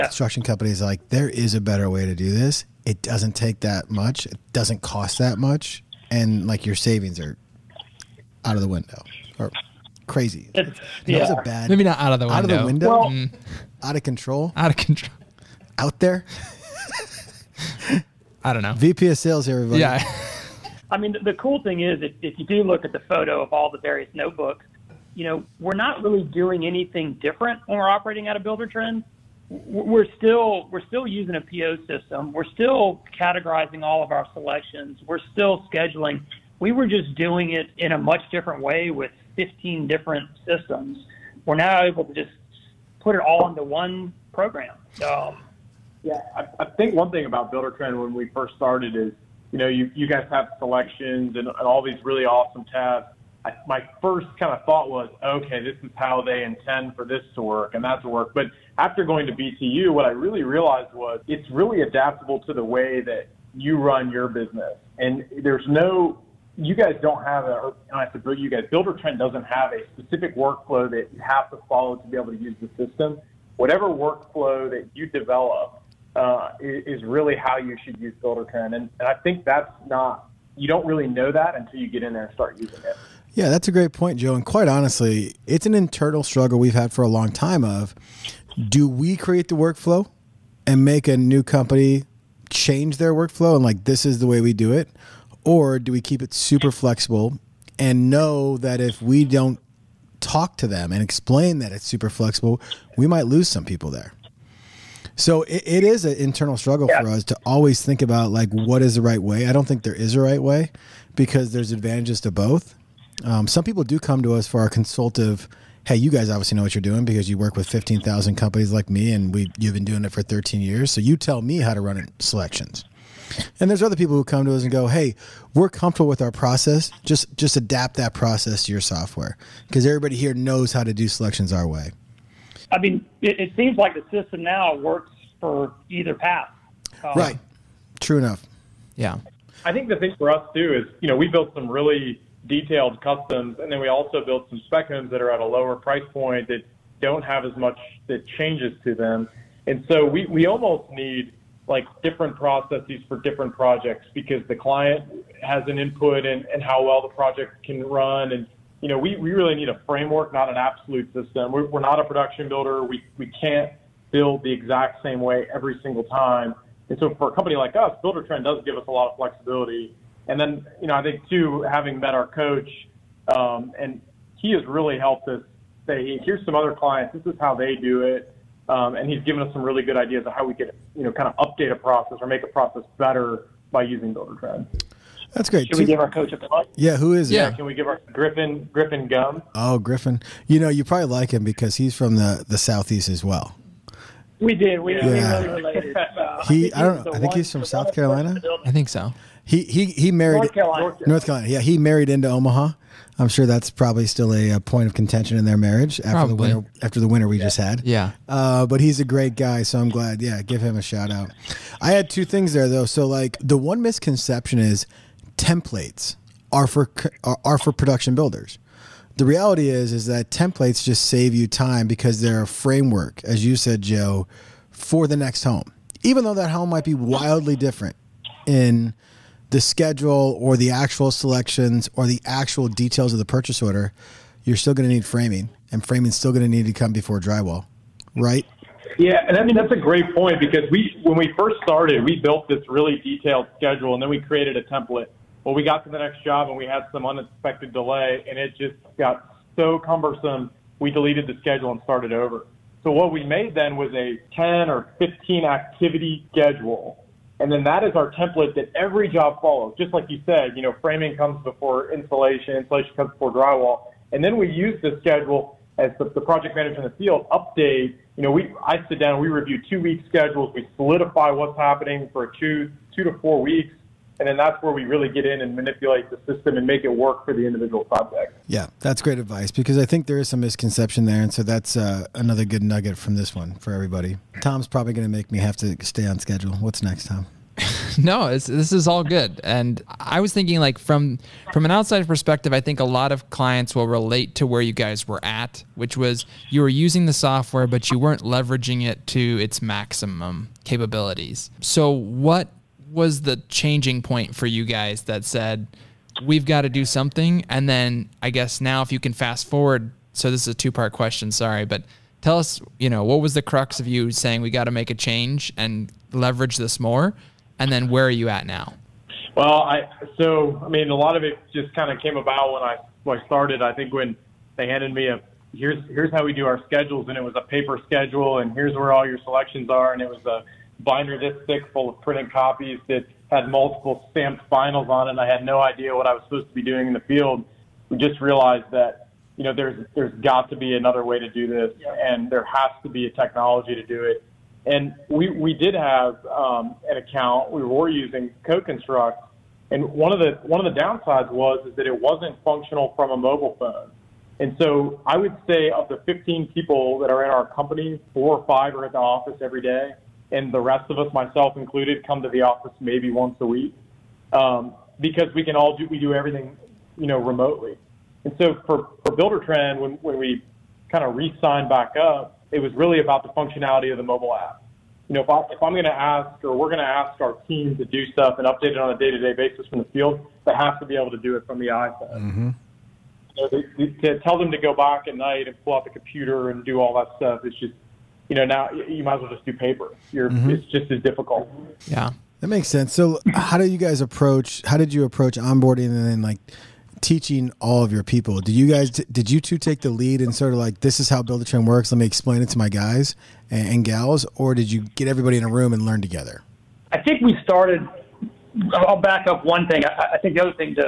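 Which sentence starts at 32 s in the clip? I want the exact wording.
We're still categorizing all of our selections.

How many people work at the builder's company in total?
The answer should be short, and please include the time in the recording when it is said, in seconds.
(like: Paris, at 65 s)
15, at 356 s.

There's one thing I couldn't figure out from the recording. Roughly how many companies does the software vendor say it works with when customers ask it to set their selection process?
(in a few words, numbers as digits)
15,000.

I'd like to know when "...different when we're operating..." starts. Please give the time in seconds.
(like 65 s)
27 s.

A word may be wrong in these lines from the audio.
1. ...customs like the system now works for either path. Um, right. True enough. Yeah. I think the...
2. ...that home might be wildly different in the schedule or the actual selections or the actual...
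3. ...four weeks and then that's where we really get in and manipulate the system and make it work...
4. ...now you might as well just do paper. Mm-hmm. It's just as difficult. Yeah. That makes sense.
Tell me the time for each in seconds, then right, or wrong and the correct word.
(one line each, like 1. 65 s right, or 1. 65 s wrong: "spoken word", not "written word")
1. 133 s wrong: "seems", not "customs"
2. 226 s right
3. 273 s right
4. 388 s right.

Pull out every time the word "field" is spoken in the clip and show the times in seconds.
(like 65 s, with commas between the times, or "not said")
266 s, 337 s, 379 s.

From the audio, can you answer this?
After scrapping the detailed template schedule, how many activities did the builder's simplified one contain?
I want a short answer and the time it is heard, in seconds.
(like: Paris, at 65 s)
10 or 15, at 254 s.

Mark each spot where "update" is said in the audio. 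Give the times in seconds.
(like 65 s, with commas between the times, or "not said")
181 s, 267 s, 378 s.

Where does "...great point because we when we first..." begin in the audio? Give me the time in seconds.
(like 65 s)
239 s.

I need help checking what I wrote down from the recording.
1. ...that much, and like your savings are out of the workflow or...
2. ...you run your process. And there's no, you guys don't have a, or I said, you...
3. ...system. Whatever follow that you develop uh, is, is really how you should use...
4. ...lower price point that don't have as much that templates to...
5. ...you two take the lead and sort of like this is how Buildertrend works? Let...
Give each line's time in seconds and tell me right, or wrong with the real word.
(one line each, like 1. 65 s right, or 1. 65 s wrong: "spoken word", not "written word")
1. 5 s wrong: "window", not "workflow"
2. 63 s wrong: "business", not "process"
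3. 72 s wrong: "workflow", not "follow"
4. 145 s wrong: "changes", not "templates"
5. 399 s right.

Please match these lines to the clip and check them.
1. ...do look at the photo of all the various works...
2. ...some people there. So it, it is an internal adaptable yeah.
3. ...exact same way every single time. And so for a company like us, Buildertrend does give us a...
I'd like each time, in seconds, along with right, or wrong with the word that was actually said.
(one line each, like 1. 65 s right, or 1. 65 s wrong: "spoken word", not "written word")
1. 22 s wrong: "notebooks", not "works"
2. 103 s wrong: "struggle", not "adaptable"
3. 164 s right.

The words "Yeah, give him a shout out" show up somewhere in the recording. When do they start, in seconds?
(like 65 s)
210 s.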